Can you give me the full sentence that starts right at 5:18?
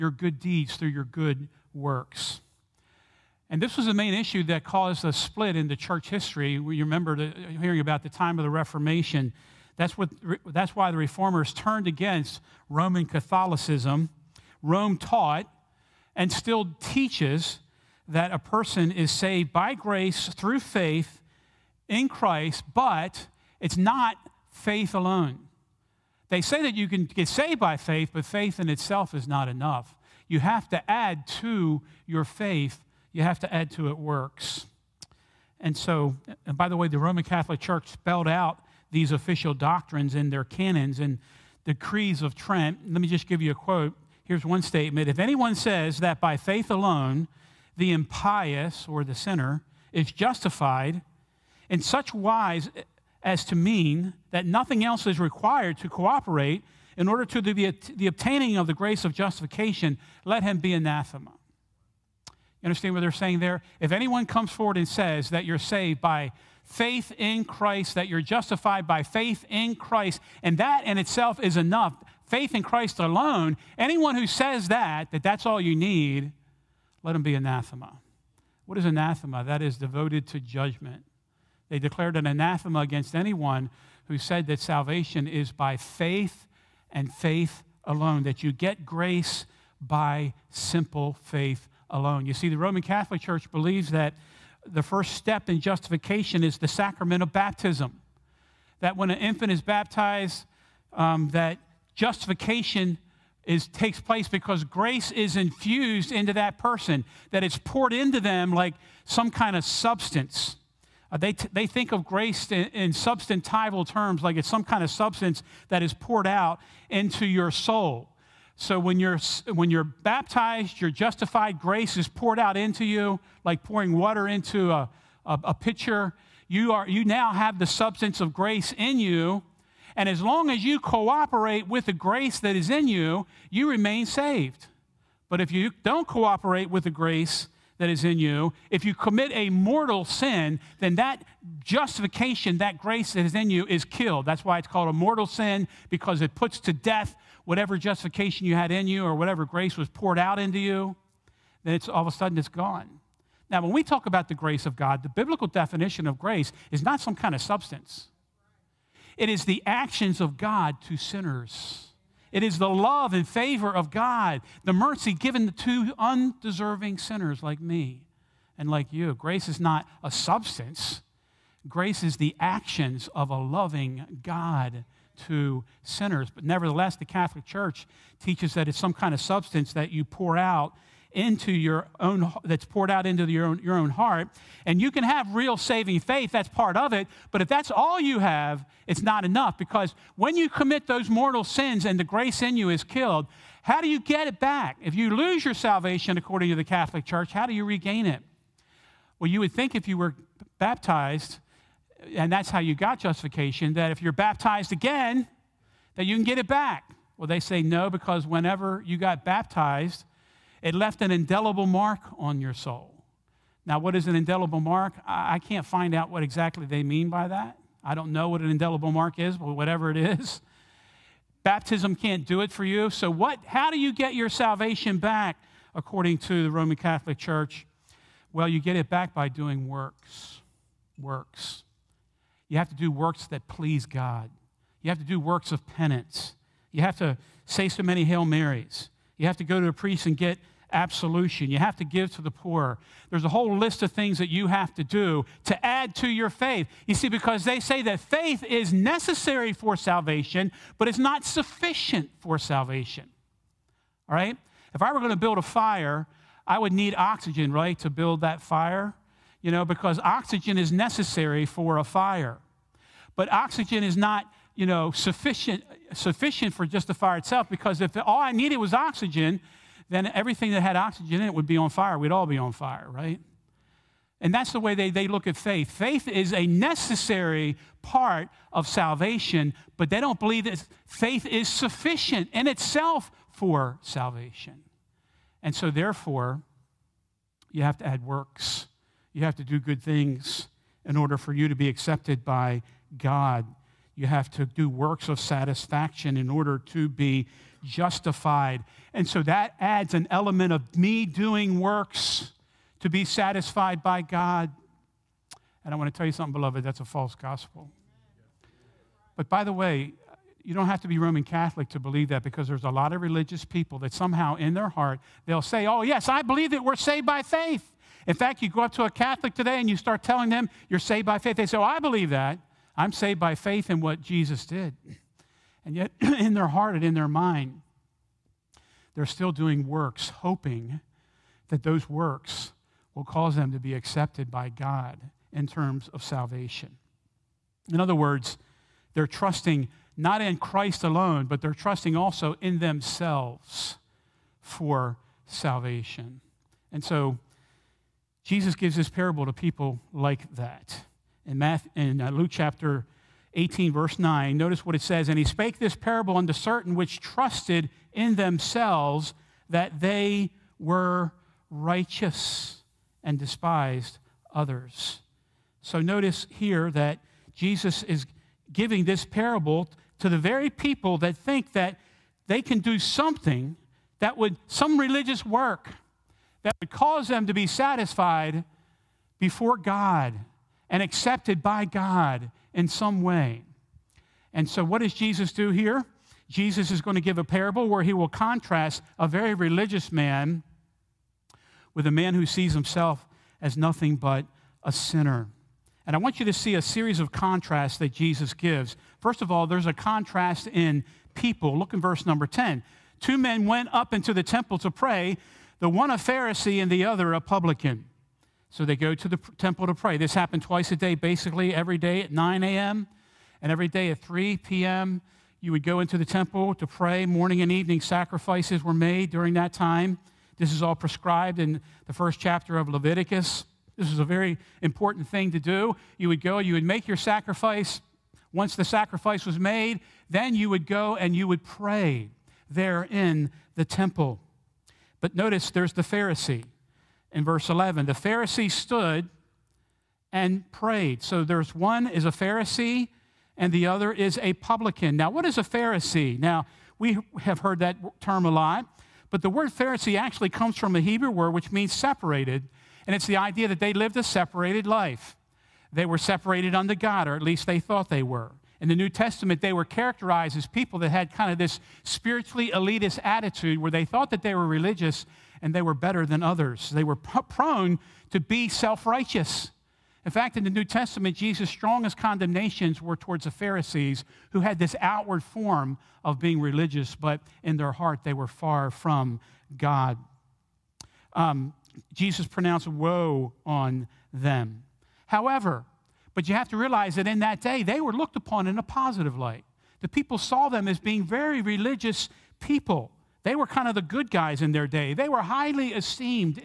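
In fact, you go up to a Catholic today and you start telling them you're saved by faith.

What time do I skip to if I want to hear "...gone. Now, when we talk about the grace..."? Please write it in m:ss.
2:32.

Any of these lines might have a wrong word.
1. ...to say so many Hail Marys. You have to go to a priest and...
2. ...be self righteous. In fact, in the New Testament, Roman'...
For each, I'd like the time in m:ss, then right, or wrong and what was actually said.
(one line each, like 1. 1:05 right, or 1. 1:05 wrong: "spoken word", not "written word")
1. 3:56 right
2. 7:48 wrong: "Jesus", not "Roman".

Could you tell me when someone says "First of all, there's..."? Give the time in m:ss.
6:39.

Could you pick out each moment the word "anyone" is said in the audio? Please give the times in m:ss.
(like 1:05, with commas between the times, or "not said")
0:45, 1:03, 1:13, 1:23.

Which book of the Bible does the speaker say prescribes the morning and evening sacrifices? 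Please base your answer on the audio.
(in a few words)
Leviticus.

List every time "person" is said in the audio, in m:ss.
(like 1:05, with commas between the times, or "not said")
0:18, 1:46.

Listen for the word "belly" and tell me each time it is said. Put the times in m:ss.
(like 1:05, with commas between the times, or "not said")
not said.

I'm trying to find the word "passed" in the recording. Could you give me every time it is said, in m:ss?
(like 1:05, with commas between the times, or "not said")
not said.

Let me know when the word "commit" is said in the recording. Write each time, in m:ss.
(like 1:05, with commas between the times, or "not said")
2:18, 3:10.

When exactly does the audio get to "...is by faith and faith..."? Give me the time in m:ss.
1:25.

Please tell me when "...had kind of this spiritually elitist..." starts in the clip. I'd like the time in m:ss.
7:40.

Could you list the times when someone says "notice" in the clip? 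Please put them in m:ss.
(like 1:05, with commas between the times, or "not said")
5:54, 6:05, 7:15.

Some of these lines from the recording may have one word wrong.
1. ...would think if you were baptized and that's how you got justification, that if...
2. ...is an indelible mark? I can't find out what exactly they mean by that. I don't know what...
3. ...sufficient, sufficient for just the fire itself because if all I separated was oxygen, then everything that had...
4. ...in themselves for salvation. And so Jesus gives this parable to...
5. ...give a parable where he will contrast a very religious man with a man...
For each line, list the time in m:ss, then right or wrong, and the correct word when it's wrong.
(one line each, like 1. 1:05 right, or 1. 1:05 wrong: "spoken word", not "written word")
1. 3:19 right
2. 3:33 right
3. 4:24 wrong: "needed", not "separated"
4. 5:42 right
5. 6:27 right.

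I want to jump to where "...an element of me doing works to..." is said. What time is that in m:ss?
4:59.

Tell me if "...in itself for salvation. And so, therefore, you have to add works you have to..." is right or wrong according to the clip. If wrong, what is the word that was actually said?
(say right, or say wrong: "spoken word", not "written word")
right.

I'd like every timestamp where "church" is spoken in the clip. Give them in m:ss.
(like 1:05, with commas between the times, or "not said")
0:05, 0:37, 1:33, 2:57, 3:17, 3:47.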